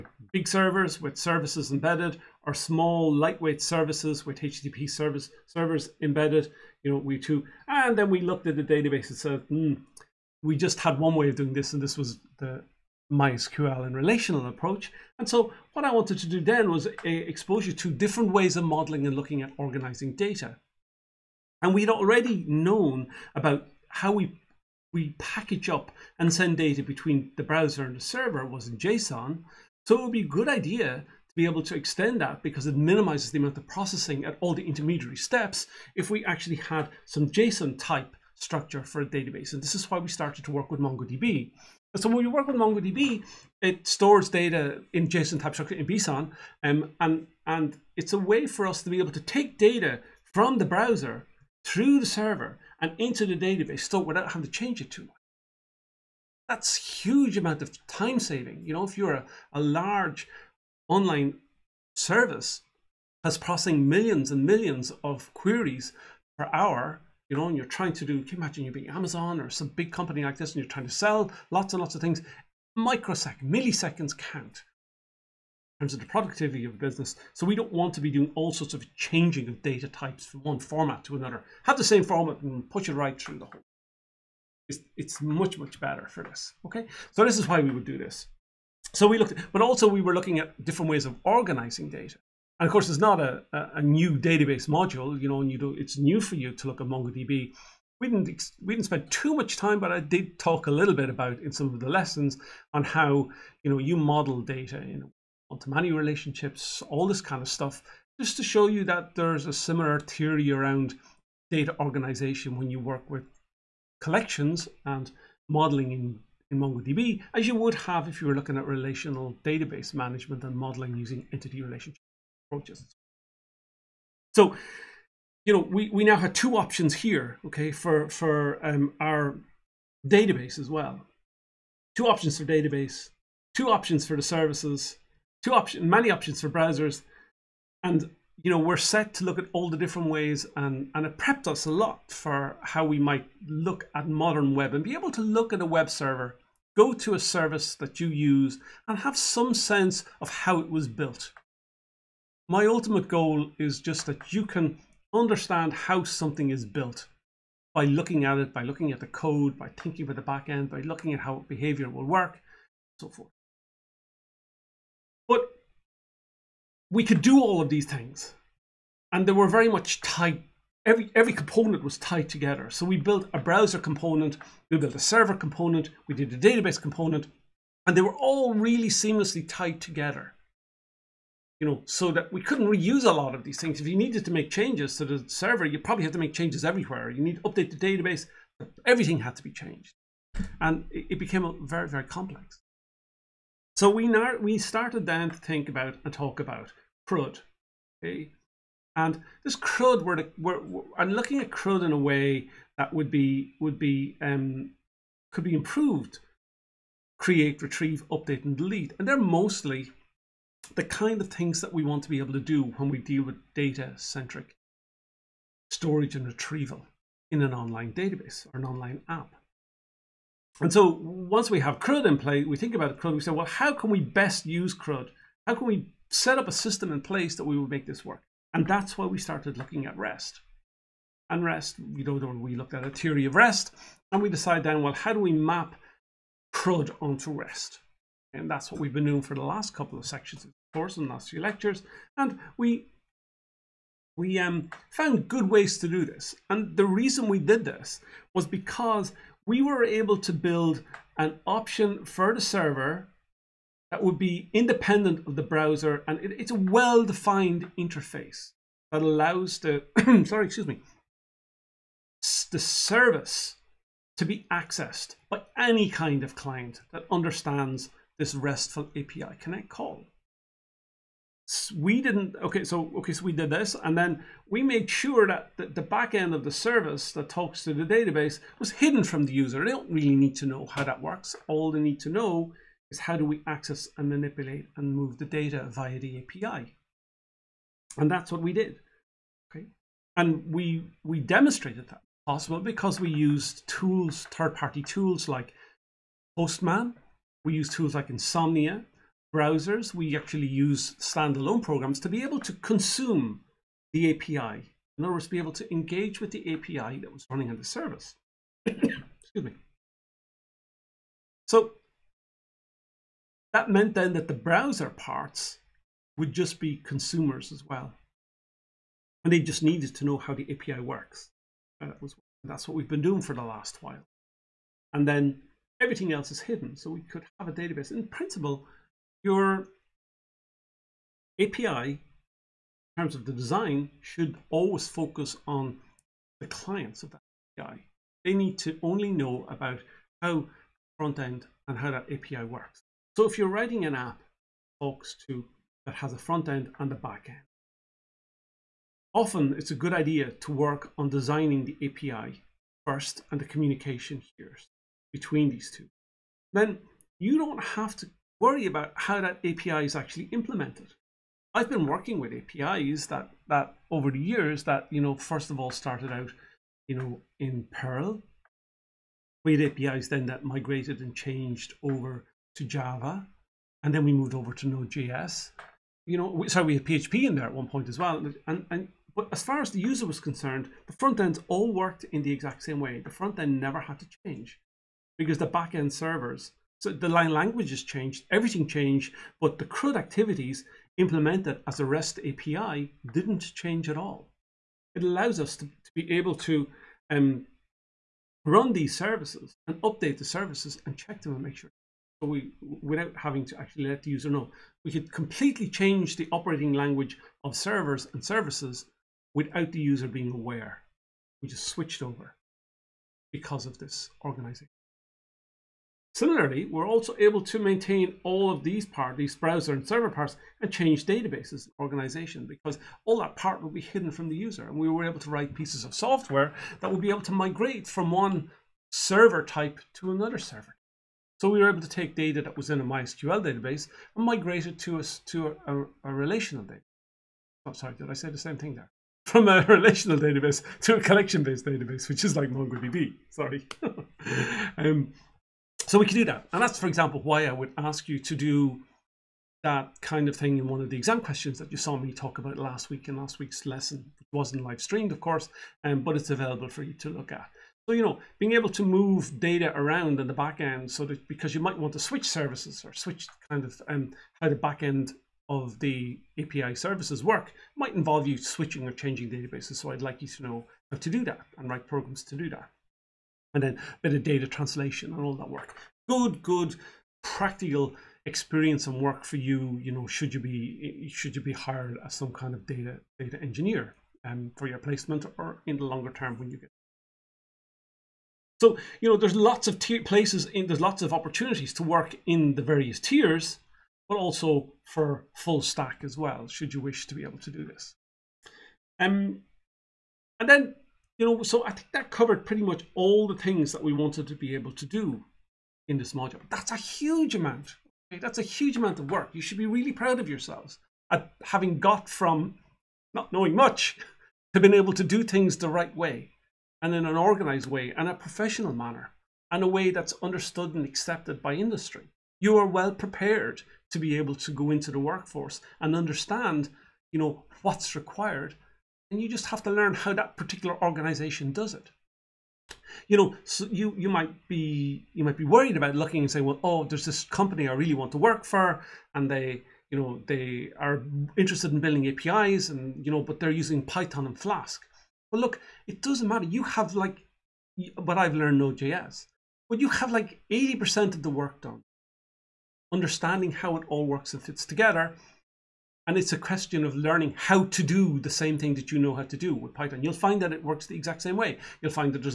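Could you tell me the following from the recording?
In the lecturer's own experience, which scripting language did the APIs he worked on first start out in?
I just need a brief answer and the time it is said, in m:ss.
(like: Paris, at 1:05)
Perl, at 6:07.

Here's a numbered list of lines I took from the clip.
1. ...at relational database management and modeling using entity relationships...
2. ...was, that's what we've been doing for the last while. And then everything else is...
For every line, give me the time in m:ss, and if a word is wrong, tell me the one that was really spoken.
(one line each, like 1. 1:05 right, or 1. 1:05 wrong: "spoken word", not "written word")
1. 1:58 right
2. 5:22 right.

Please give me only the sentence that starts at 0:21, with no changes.
And we'd already known about how we, we package up and send data between the browser and the server was in JSON.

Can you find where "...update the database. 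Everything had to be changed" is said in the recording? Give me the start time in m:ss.
3:07.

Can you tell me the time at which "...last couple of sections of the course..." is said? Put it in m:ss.
3:59.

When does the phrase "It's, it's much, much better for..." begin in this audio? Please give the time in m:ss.
1:24.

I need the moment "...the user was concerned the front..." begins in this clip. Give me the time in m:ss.
6:19.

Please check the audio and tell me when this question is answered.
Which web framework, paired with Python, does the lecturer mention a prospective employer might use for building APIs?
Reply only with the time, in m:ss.
9:04.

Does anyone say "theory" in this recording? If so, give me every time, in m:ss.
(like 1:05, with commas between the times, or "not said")
1:50, 3:52.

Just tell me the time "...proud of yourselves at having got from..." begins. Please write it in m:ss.
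8:29.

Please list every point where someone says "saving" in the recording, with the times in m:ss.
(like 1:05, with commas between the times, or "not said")
0:58.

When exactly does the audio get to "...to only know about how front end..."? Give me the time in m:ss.
5:38.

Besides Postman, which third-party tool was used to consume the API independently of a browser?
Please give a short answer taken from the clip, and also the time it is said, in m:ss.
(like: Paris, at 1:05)
Insomnia, at 4:58.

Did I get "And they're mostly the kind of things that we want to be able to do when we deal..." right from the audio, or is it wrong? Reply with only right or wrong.
right.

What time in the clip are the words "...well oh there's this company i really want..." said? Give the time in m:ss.
8:56.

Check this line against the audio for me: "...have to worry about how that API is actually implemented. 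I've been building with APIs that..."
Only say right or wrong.
wrong.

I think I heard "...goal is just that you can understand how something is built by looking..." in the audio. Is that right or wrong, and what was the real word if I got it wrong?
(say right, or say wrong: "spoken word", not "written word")
right.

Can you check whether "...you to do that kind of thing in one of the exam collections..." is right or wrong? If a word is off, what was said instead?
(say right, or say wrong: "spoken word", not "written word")
wrong: "questions", not "collections".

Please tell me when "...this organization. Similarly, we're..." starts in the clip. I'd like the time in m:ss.
6:53.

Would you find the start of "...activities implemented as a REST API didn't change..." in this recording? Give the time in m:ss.
6:29.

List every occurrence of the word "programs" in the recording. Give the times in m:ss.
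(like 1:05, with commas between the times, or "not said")
5:01, 7:51.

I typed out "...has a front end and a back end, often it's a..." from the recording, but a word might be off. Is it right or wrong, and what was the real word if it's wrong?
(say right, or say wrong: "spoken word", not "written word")
right.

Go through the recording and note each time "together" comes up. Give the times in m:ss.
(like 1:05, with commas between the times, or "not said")
2:52, 2:59, 9:14.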